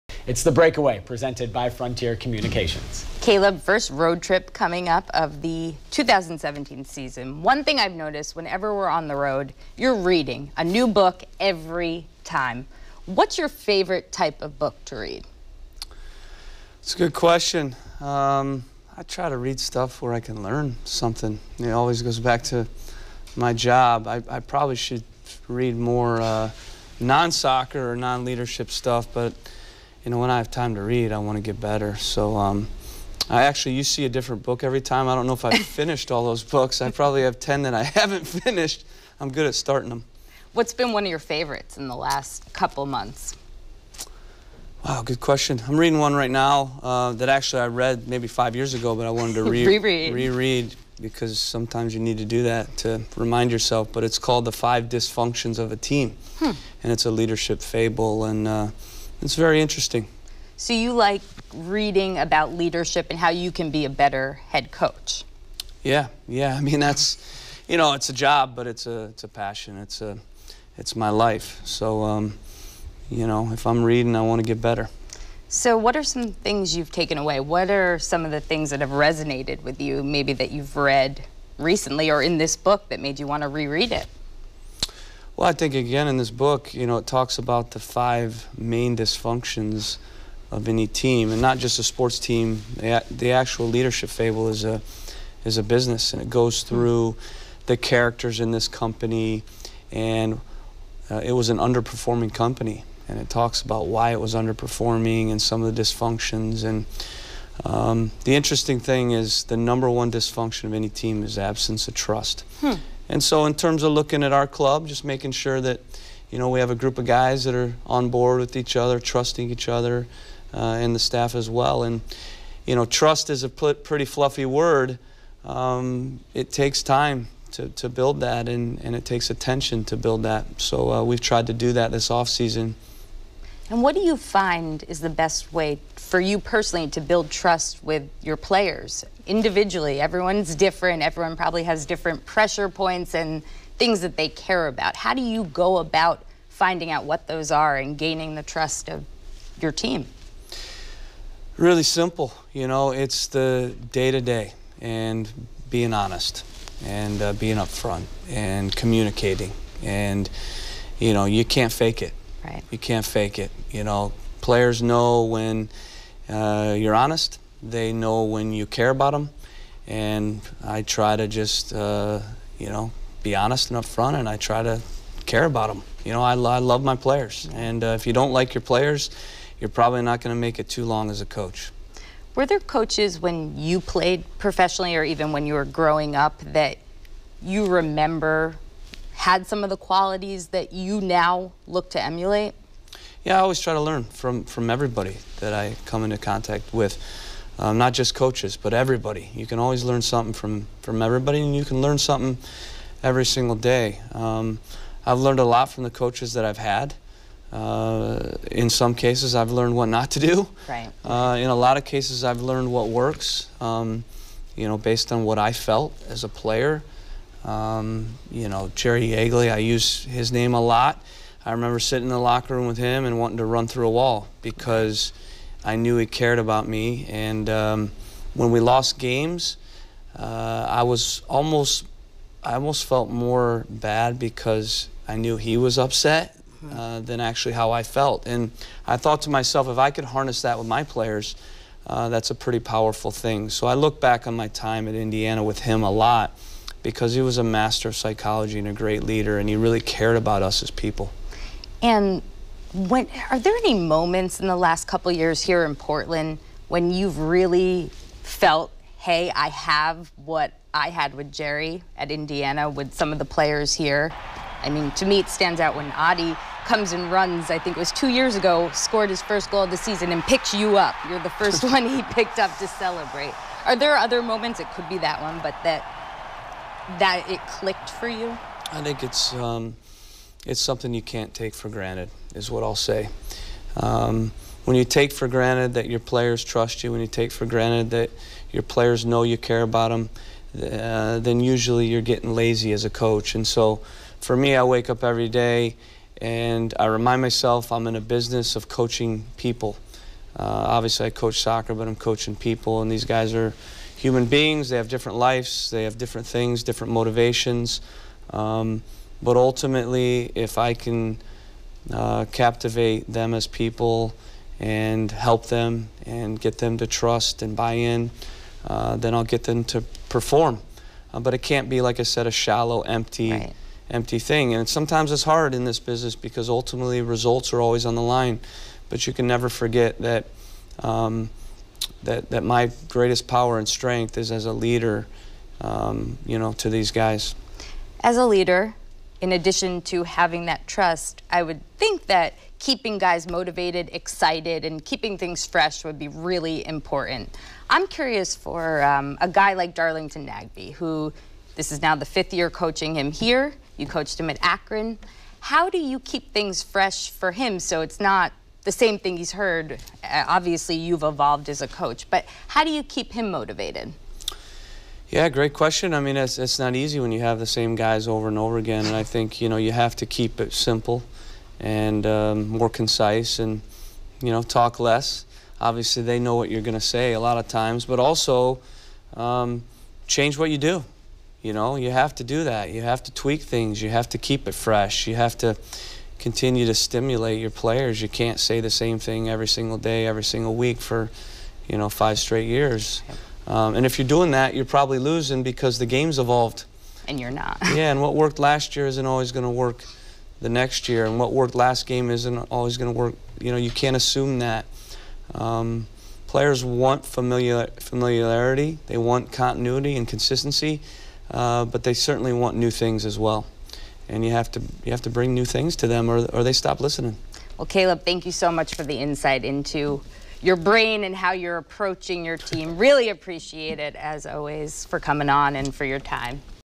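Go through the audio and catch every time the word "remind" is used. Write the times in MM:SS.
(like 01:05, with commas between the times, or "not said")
00:53, 04:56.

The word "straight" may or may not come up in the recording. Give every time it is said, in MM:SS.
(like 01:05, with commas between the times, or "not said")
06:32.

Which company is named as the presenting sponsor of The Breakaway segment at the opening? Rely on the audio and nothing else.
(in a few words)
Frontier Communications.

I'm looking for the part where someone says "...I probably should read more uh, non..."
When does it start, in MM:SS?
00:24.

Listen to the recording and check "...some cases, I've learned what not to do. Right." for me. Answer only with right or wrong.
right.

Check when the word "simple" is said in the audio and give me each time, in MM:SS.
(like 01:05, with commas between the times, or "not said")
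02:31, 06:10.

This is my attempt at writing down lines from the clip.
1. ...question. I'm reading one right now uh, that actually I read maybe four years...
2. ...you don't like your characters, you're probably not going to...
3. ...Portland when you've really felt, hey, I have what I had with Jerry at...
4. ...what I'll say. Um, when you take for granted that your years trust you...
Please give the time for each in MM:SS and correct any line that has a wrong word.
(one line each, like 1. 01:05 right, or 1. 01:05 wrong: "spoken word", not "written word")
1. 00:45 wrong: "five", not "four"
2. 02:58 wrong: "players", not "characters"
3. 04:15 right
4. 04:42 wrong: "players", not "years".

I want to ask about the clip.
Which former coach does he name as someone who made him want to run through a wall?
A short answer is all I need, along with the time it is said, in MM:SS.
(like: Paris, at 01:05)
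Jerry Yeagley, at 03:38.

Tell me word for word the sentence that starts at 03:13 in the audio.
Yeah, I always try to learn from, from everybody that I come into contact with.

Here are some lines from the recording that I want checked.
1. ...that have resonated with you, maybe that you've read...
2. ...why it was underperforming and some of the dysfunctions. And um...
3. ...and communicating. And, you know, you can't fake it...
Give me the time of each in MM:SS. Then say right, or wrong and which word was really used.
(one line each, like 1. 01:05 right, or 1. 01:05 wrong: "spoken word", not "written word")
1. 01:18 right
2. 01:43 right
3. 02:38 right.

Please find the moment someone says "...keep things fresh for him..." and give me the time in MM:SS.
05:55.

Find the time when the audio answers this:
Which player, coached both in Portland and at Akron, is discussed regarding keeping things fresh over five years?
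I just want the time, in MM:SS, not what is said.
05:49.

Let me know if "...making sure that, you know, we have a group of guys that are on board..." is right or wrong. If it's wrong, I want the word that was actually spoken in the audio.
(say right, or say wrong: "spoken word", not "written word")
right.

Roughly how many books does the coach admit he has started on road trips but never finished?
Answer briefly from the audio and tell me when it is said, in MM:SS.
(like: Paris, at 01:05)
10, at 00:37.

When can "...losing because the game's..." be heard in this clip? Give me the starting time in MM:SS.
06:34.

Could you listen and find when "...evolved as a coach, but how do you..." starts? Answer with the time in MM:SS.
06:01.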